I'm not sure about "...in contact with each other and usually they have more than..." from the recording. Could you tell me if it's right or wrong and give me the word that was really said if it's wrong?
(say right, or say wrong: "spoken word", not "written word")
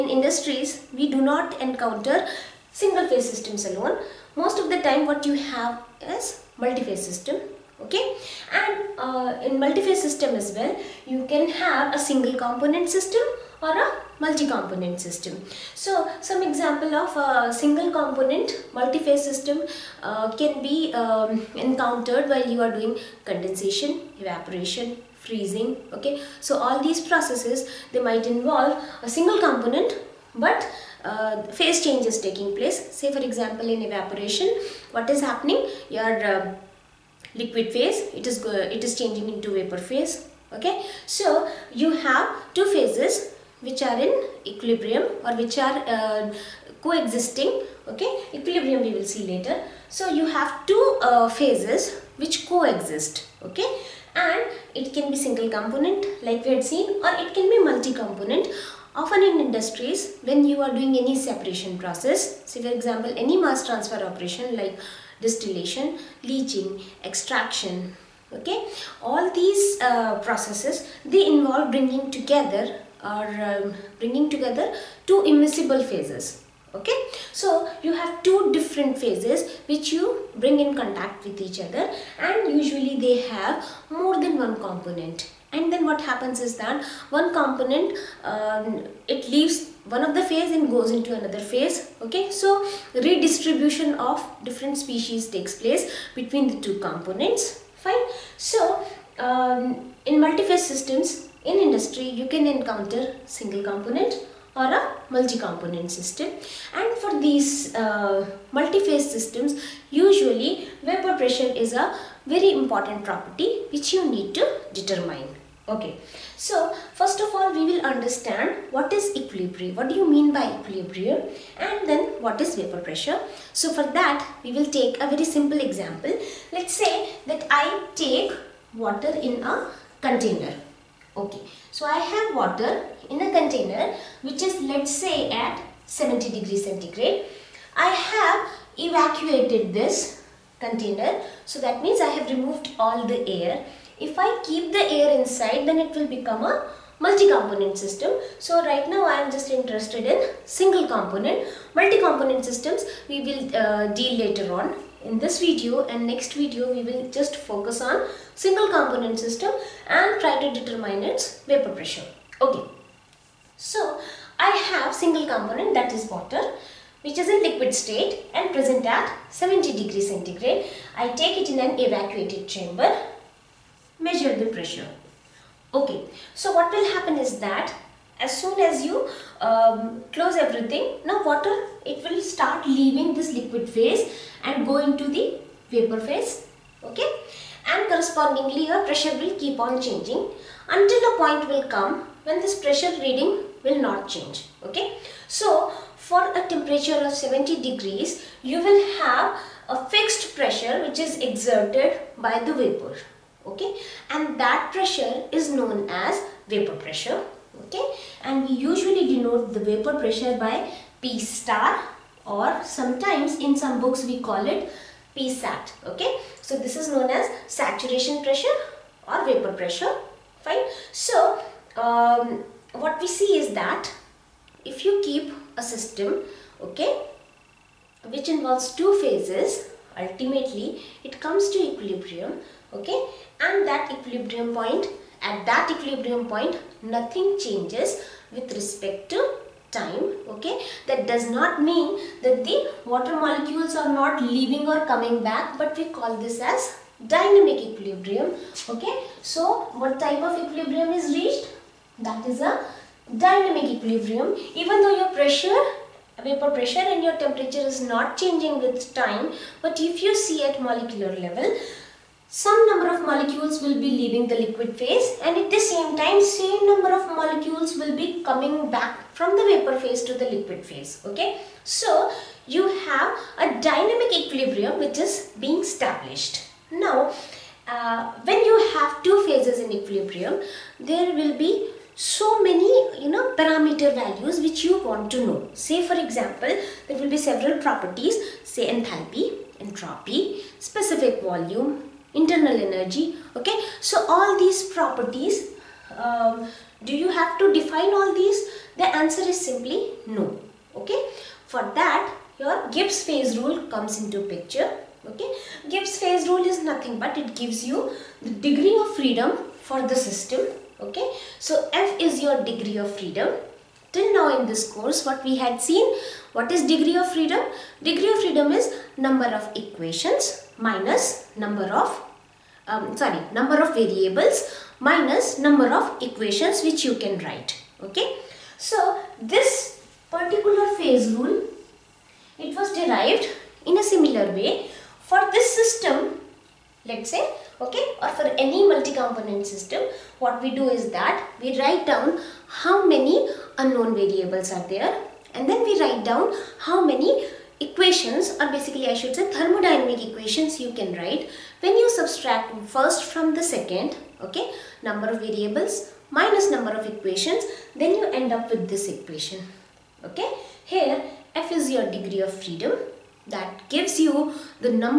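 right.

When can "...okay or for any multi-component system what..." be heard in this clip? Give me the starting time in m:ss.
5:37.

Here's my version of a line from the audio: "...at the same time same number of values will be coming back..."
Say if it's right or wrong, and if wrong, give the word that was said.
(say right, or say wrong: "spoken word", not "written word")
wrong: "molecules", not "values".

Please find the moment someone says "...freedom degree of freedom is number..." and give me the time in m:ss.
5:17.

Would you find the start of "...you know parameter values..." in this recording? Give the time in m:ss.
4:43.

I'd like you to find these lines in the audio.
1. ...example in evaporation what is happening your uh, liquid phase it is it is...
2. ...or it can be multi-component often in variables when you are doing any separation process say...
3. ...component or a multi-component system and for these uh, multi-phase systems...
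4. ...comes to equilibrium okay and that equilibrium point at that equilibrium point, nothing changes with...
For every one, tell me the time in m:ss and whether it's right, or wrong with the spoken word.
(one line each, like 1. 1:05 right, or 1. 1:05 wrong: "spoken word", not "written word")
1. 0:33 right
2. 0:57 wrong: "industries", not "variables"
3. 1:43 right
4. 3:51 right.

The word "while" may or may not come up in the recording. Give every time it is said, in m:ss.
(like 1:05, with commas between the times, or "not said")
0:22.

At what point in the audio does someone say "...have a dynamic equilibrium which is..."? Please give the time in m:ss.
4:32.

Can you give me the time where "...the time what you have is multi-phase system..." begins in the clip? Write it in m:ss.
0:04.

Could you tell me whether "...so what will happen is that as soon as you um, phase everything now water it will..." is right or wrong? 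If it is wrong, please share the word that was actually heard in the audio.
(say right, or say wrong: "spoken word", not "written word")
wrong: "close", not "phase".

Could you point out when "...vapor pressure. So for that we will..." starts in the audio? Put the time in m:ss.
2:02.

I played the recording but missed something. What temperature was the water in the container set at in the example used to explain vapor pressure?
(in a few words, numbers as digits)
70 degrees centigrade.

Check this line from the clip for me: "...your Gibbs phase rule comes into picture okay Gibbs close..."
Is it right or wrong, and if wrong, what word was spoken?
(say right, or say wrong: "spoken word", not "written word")
wrong: "phase", not "close".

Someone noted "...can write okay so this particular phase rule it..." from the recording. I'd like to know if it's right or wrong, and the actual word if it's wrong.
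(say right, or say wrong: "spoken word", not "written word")
right.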